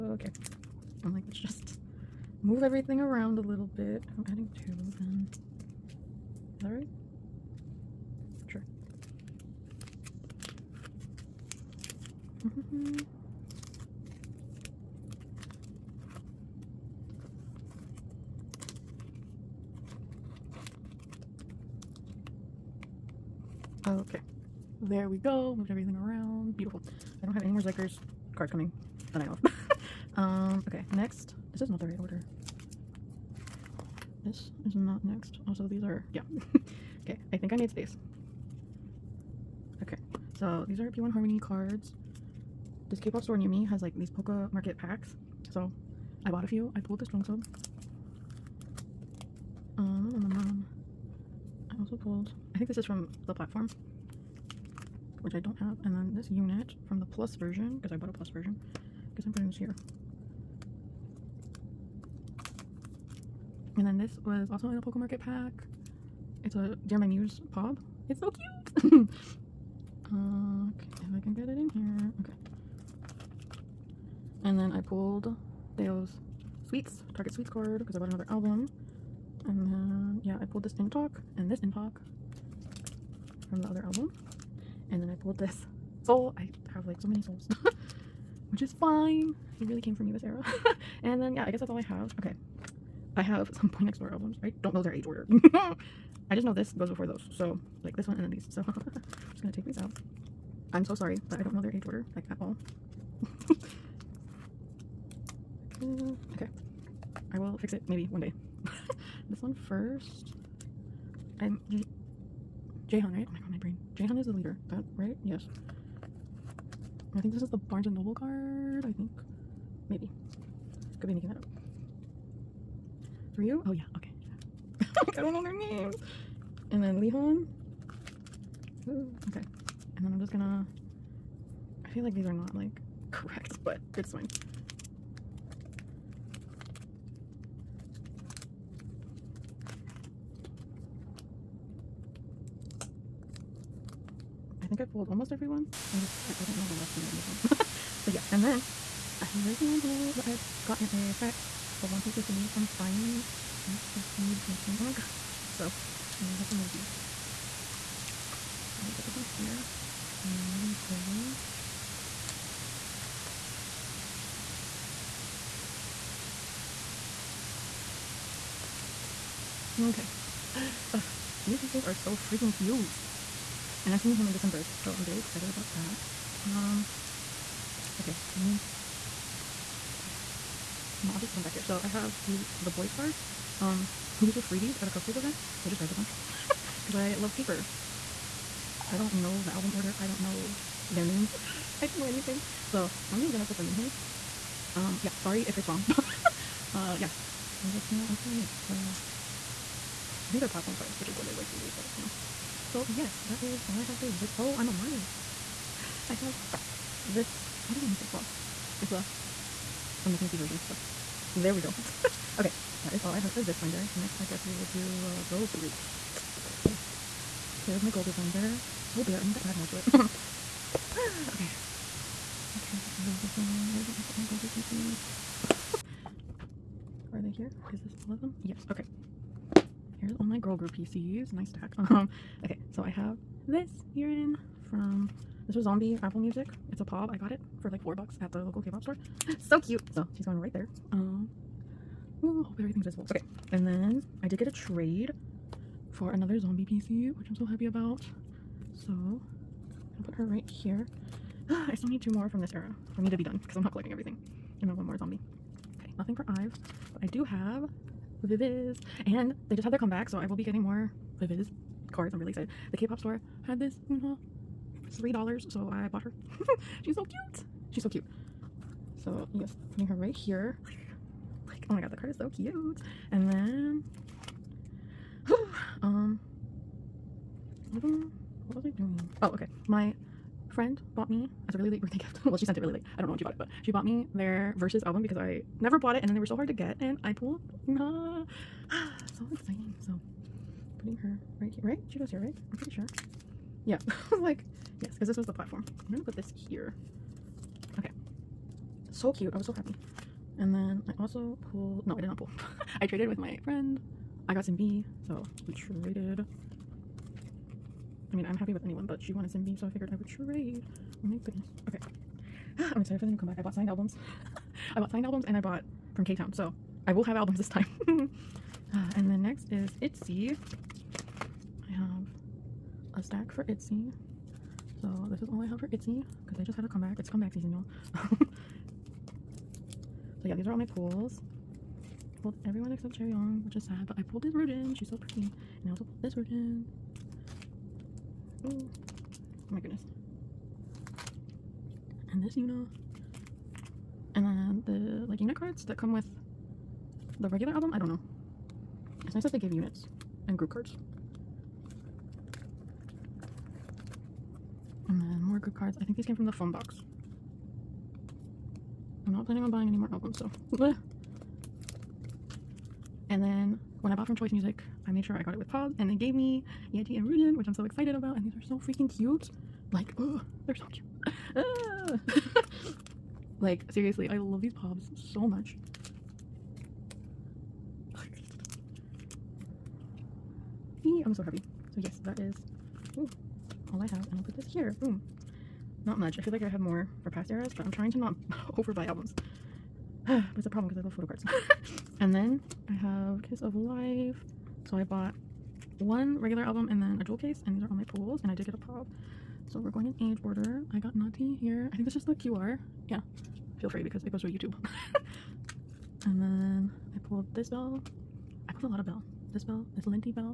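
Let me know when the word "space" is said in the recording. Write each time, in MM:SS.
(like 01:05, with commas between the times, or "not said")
00:37.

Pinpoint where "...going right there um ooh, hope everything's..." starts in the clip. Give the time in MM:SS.
04:00.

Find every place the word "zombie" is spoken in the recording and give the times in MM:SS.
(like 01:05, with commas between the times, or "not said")
03:55, 04:06, 04:14.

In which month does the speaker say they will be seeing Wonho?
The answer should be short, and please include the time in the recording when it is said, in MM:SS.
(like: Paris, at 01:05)
December, at 02:54.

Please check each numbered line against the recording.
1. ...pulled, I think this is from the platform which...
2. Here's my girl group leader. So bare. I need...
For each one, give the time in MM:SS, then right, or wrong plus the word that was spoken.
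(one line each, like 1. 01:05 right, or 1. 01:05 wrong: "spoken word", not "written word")
1. 00:52 right
2. 03:37 wrong: "binder", not "leader".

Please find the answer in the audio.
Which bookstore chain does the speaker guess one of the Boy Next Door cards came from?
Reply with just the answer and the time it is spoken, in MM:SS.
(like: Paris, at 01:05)
Barnes and Noble, at 01:57.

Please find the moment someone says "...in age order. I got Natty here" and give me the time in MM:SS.
06:39.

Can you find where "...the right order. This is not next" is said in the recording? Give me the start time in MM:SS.
00:31.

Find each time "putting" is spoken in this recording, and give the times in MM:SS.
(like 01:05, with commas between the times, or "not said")
00:59, 03:18, 04:29, 04:50.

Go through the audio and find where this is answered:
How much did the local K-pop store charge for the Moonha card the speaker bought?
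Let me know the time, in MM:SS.
04:24.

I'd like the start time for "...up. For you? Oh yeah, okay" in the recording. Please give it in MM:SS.
02:01.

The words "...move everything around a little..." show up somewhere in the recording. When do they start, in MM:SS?
00:02.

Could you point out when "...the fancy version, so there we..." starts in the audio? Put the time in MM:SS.
03:30.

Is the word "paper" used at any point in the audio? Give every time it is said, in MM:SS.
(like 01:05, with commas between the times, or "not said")
03:07.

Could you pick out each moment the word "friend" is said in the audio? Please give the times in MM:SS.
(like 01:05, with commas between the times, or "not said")
04:40, 05:03.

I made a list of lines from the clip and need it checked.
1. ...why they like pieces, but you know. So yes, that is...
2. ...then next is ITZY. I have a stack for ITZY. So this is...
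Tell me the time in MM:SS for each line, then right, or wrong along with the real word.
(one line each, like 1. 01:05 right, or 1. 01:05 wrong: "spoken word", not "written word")
1. 03:21 wrong: "freebies", not "pieces"
2. 05:19 right.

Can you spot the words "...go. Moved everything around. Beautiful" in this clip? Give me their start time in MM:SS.
00:25.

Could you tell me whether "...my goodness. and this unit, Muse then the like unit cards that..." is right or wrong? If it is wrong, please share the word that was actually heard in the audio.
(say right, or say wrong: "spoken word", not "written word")
wrong: "And", not "Muse".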